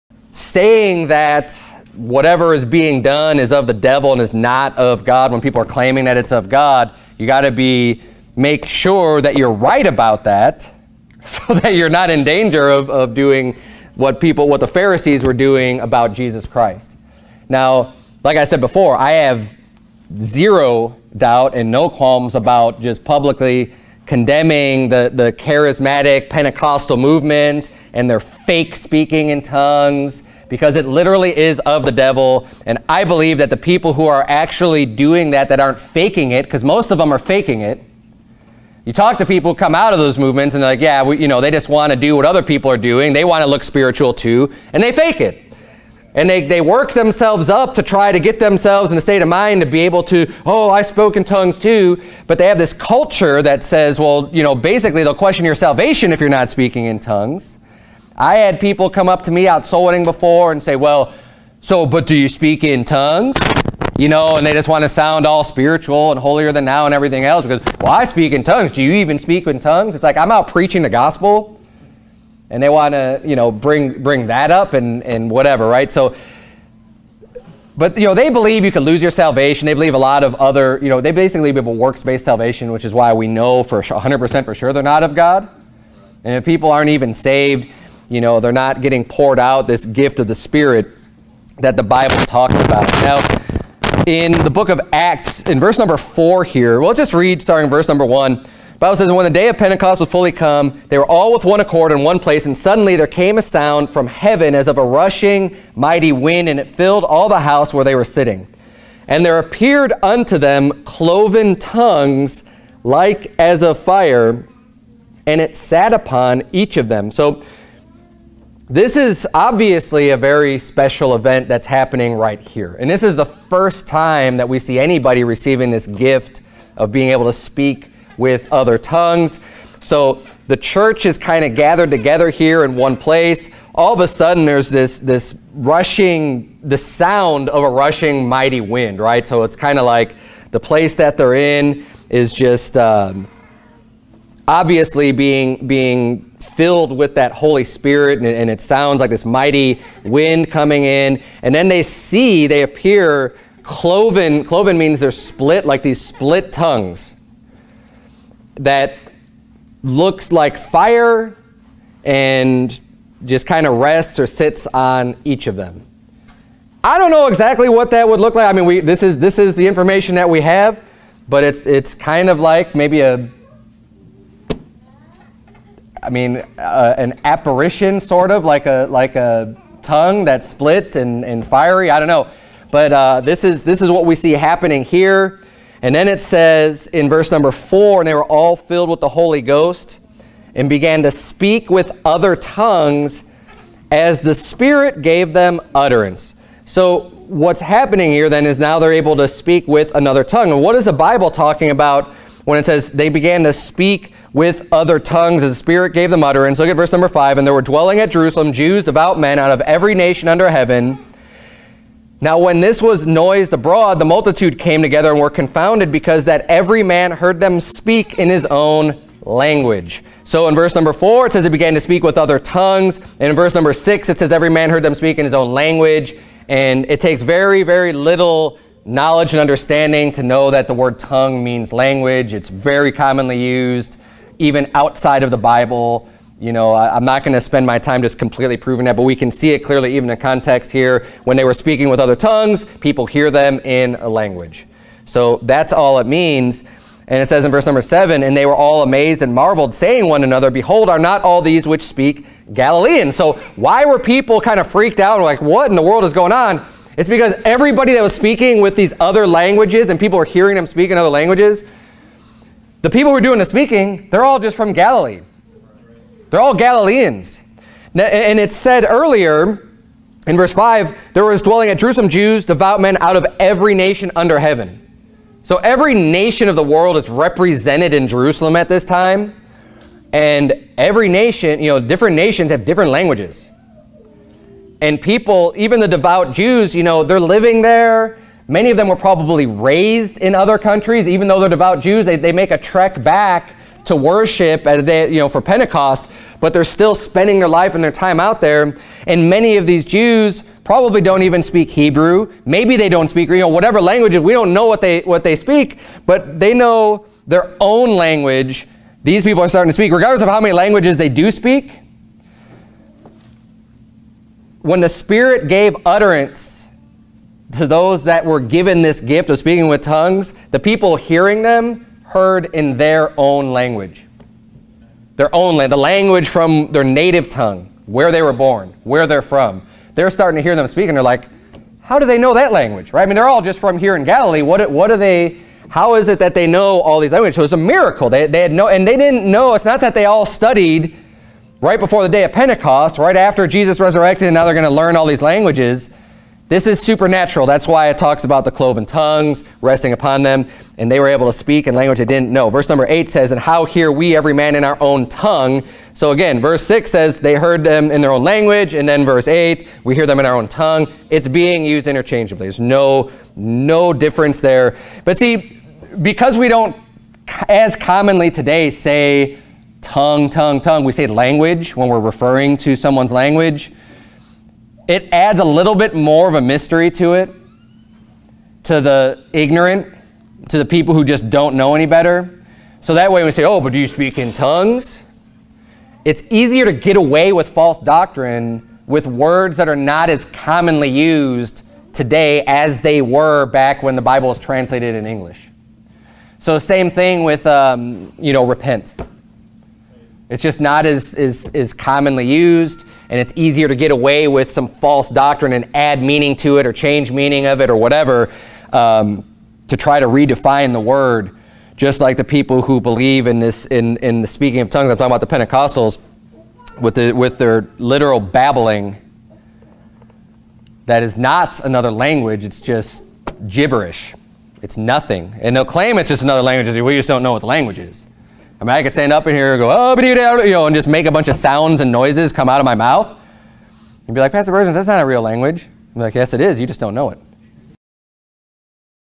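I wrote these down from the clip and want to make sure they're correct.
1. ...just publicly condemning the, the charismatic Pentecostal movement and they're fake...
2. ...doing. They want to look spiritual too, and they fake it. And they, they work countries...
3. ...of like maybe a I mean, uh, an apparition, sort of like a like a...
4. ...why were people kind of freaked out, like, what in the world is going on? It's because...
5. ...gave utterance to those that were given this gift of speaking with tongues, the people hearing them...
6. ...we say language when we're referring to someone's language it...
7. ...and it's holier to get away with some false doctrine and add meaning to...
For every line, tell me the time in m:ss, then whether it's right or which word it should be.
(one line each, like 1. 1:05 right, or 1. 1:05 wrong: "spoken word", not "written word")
1. 0:22 right
2. 0:42 wrong: "themselves", not "countries"
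3. 2:52 right
4. 4:13 right
5. 5:15 right
6. 6:10 right
7. 6:43 wrong: "easier", not "holier".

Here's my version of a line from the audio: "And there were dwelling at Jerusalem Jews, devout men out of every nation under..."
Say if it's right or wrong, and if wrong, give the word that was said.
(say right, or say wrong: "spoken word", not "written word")
right.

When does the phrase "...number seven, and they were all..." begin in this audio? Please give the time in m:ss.
4:07.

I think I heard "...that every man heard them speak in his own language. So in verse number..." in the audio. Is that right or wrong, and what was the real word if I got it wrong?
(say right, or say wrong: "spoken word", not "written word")
right.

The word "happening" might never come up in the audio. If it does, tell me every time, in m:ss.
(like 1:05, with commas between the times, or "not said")
2:01, 3:04, 3:17.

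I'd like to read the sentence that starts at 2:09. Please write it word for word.
So the church is kind of gathered together here in one place.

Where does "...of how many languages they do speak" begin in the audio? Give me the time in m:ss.
5:10.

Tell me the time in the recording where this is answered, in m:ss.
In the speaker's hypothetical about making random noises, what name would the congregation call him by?
7:14.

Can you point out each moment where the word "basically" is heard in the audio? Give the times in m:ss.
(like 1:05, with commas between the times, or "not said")
0:54, 1:21.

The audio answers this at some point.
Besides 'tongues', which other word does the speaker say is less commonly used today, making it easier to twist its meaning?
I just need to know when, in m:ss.
6:38.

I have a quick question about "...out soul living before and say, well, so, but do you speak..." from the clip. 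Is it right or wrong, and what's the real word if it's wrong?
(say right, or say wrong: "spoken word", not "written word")
wrong: "winning", not "living".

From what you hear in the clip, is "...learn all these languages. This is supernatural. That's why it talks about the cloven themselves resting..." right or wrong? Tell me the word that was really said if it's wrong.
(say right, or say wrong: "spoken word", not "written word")
wrong: "tongues", not "themselves".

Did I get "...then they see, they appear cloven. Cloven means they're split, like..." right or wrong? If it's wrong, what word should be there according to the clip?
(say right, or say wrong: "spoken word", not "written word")
right.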